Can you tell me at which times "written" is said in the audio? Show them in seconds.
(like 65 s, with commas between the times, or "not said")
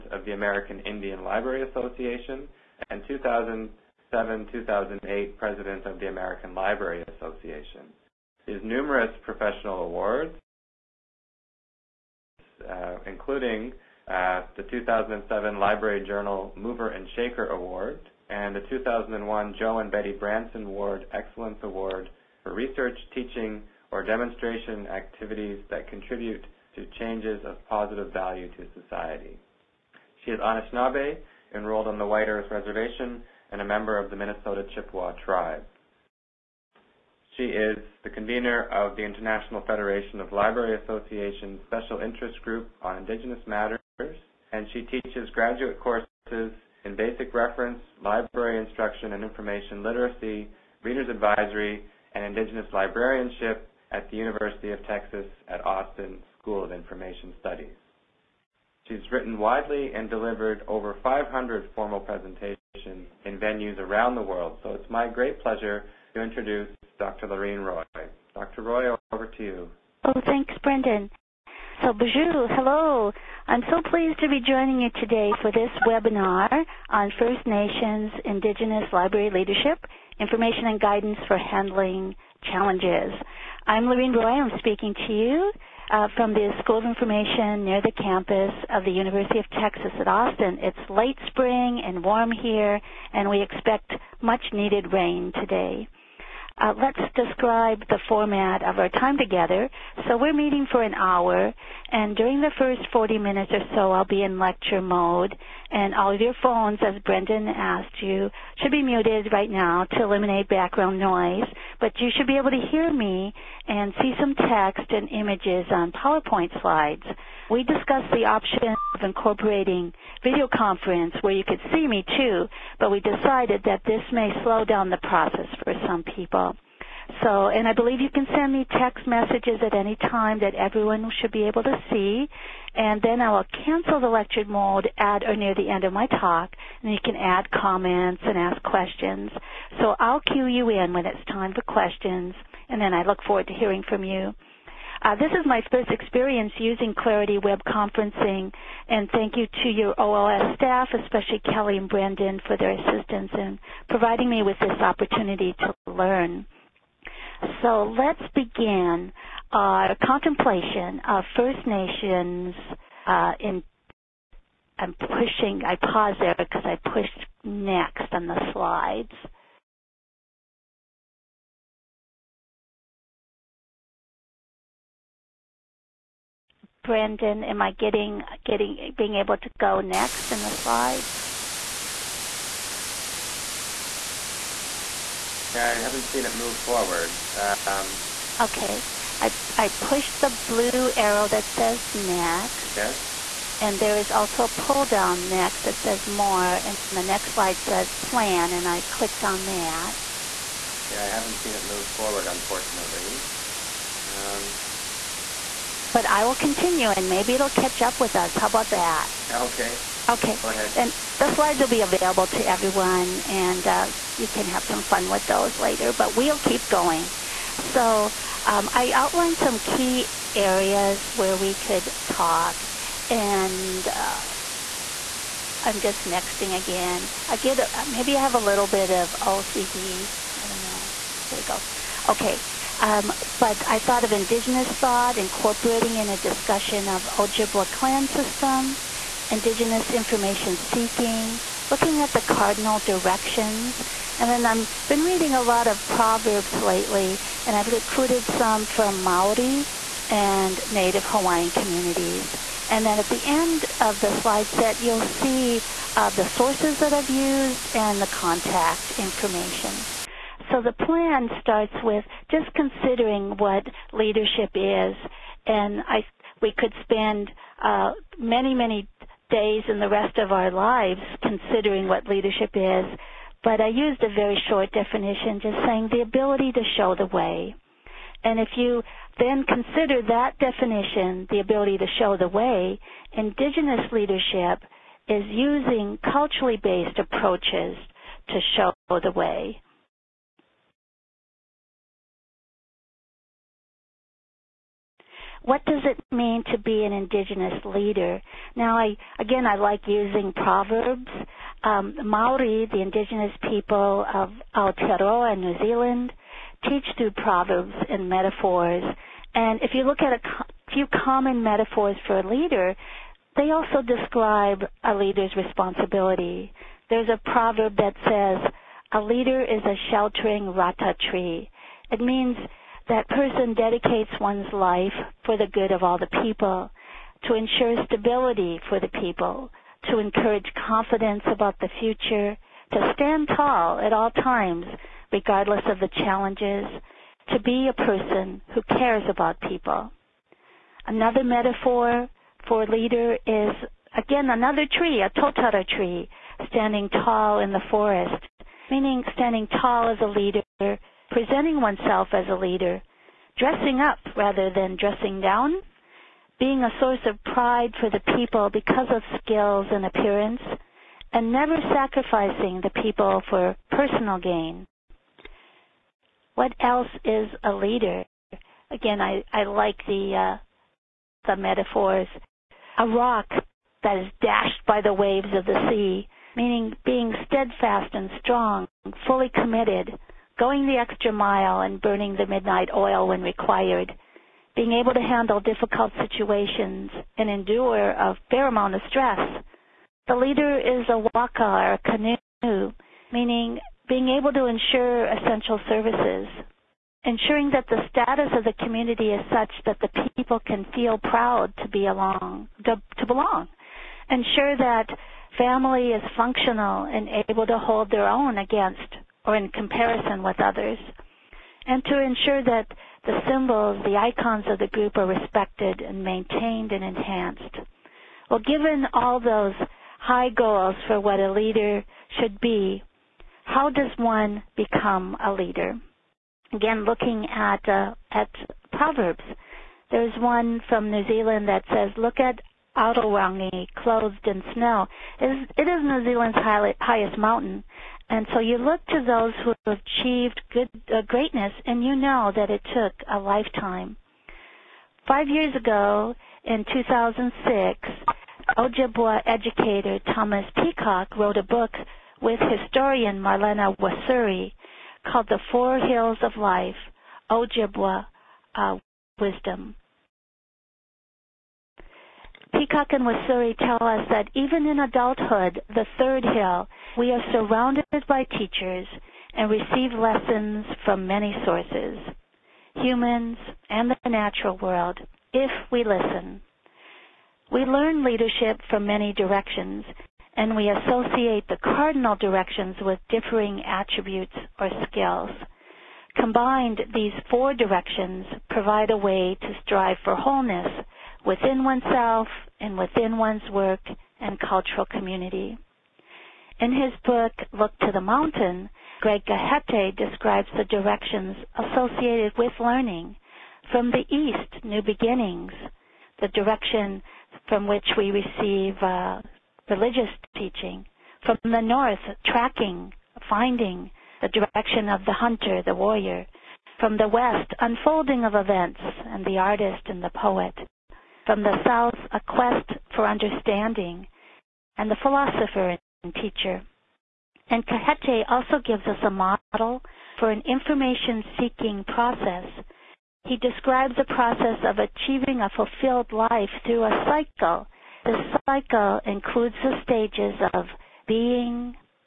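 59 s.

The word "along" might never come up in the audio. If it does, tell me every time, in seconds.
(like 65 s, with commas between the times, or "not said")
401 s.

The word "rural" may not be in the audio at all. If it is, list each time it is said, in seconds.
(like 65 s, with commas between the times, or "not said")
not said.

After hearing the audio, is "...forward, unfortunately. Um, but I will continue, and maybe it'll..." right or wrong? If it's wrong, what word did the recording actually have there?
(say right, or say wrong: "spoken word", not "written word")
right.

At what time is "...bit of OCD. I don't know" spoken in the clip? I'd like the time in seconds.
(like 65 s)
228 s.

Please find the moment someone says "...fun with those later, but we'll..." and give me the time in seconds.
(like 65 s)
214 s.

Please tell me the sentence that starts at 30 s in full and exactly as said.
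She is Anishinaabe, enrolled on the White Earth Reservation, and a member of the Minnesota Chippewa tribe.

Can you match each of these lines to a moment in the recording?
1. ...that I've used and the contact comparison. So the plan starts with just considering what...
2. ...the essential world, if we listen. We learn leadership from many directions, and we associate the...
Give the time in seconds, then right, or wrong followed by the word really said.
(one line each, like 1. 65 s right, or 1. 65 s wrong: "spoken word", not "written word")
1. 256 s wrong: "information", not "comparison"
2. 473 s wrong: "natural", not "essential".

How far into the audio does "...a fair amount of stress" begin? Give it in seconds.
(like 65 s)
387 s.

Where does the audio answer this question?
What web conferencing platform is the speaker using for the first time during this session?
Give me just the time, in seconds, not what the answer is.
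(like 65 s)
146 s.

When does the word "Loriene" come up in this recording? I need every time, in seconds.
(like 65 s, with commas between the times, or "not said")
67 s, 83 s.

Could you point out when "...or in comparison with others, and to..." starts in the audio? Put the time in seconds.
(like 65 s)
409 s.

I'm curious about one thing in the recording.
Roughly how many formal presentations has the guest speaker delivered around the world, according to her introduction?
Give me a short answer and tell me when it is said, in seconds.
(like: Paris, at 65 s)
500, at 61 s.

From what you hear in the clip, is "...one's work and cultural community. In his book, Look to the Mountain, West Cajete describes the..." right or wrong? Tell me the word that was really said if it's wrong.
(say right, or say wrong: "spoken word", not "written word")
wrong: "Greg", not "West".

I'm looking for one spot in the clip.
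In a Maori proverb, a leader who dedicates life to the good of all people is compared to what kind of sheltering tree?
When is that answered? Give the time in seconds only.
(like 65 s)
320 s.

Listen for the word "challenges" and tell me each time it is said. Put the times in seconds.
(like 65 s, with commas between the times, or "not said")
82 s, 335 s.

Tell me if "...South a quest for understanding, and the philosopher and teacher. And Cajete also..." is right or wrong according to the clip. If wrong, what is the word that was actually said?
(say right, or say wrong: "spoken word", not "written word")
right.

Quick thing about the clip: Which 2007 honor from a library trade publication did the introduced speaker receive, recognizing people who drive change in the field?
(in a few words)
Library Journal Mover and Shaker Award.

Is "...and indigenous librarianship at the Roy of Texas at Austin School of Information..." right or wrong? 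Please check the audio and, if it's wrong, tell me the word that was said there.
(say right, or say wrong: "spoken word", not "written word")
wrong: "University", not "Roy".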